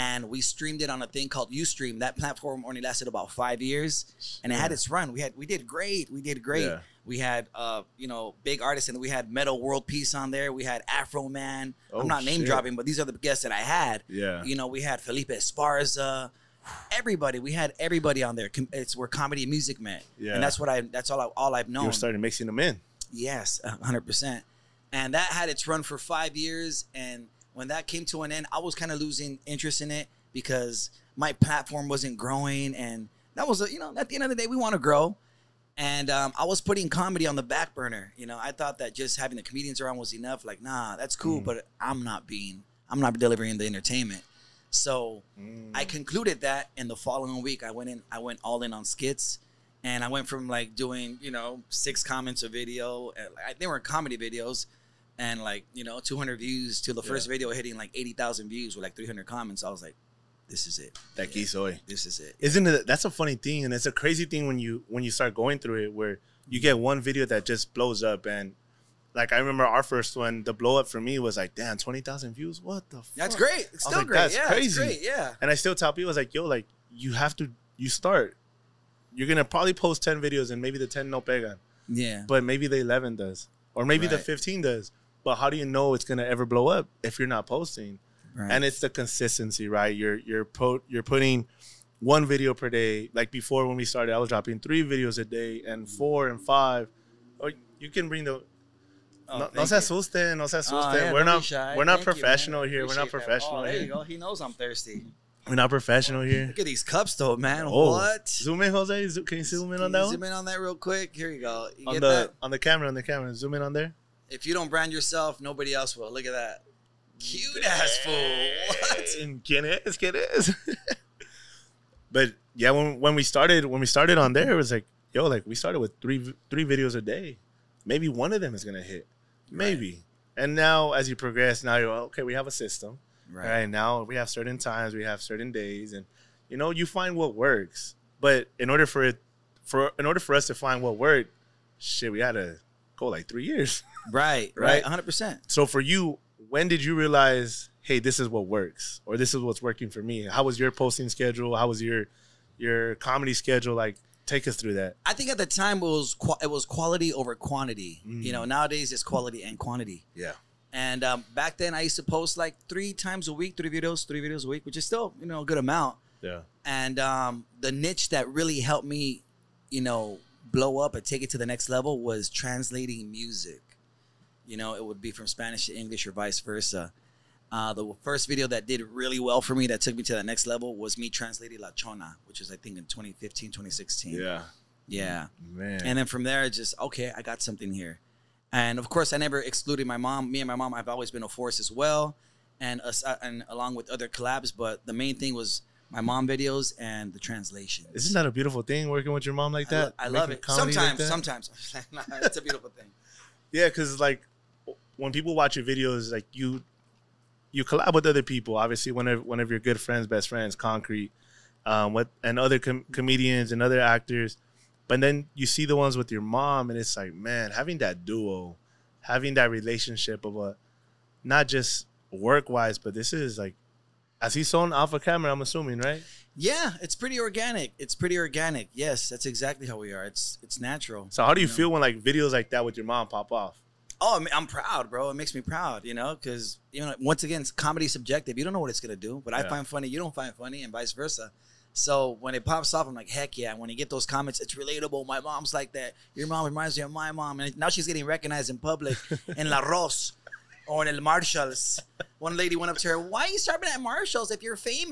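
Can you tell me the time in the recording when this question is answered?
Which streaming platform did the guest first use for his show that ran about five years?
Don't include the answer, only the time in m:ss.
0:01.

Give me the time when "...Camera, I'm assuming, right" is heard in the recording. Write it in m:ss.
3:45.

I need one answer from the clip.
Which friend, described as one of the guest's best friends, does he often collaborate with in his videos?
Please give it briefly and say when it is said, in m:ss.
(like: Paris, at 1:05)
Concrete, at 3:30.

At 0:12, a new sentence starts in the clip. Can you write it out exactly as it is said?
dropping, but these are the guests that I had.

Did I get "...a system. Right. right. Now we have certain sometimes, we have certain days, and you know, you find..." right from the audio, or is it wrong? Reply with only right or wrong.
wrong.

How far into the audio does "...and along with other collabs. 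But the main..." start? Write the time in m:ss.
3:13.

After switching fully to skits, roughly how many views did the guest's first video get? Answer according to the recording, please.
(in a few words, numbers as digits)
80,000.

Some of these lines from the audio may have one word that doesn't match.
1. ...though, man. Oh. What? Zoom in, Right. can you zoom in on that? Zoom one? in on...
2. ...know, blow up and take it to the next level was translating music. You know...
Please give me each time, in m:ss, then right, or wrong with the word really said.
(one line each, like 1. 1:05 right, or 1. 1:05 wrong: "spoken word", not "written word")
1. 1:47 wrong: "Jose", not "Right"
2. 2:49 right.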